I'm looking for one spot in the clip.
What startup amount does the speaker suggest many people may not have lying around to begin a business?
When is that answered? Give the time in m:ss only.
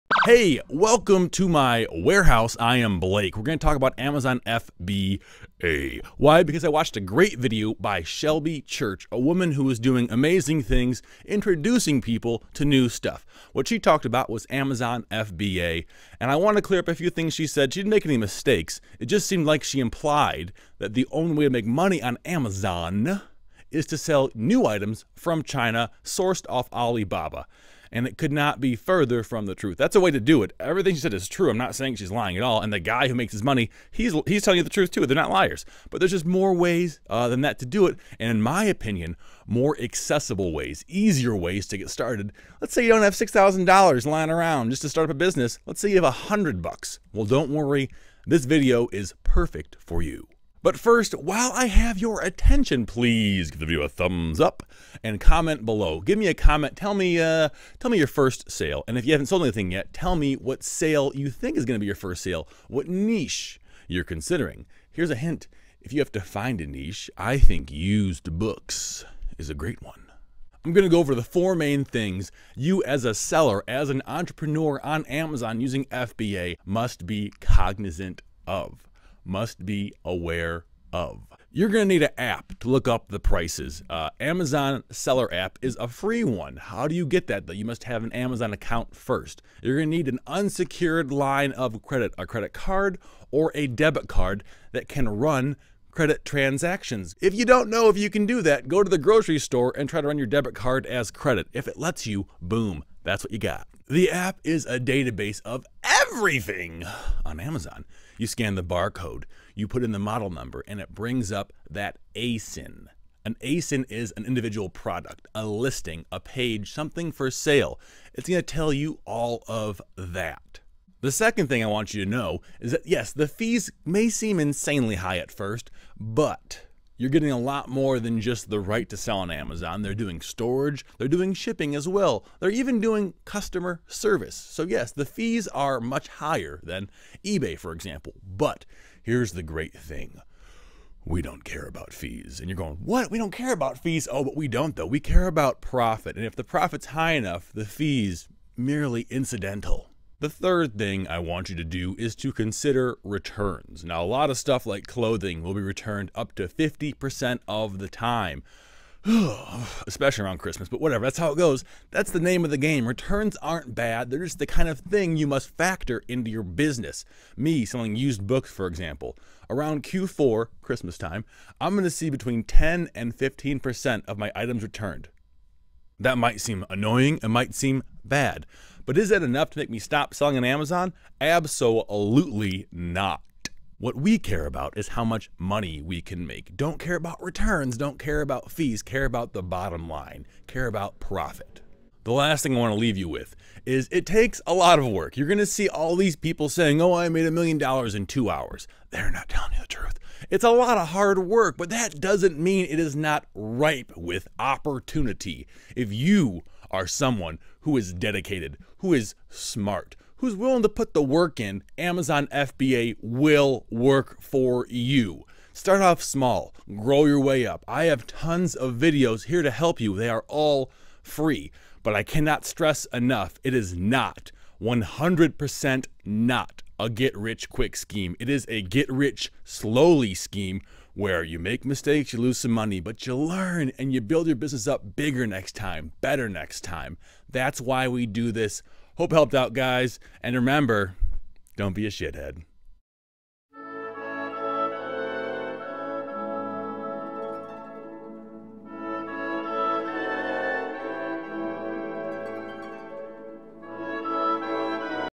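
0:43.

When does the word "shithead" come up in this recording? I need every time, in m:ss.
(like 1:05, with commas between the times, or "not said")
4:01.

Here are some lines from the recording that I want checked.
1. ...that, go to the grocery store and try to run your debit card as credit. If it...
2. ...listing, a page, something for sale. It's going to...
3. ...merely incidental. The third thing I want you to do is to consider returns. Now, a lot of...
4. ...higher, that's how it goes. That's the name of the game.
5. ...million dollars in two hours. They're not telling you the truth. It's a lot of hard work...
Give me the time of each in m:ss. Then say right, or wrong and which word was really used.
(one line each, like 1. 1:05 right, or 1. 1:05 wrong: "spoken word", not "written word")
1. 1:38 right
2. 1:55 right
3. 2:28 right
4. 2:40 wrong: "whatever", not "higher"
5. 3:17 right.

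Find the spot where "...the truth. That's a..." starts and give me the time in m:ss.
0:29.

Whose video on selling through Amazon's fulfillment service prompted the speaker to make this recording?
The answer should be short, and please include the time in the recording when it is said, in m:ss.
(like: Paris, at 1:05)
Shelby Church, at 0:08.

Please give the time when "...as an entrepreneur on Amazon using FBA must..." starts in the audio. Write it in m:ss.
1:13.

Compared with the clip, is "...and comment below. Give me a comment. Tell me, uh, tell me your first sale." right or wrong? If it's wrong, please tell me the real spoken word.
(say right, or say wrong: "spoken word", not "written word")
right.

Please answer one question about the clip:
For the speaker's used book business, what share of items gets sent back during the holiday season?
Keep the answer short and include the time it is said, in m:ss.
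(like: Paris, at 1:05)
10 to 15%, at 2:52.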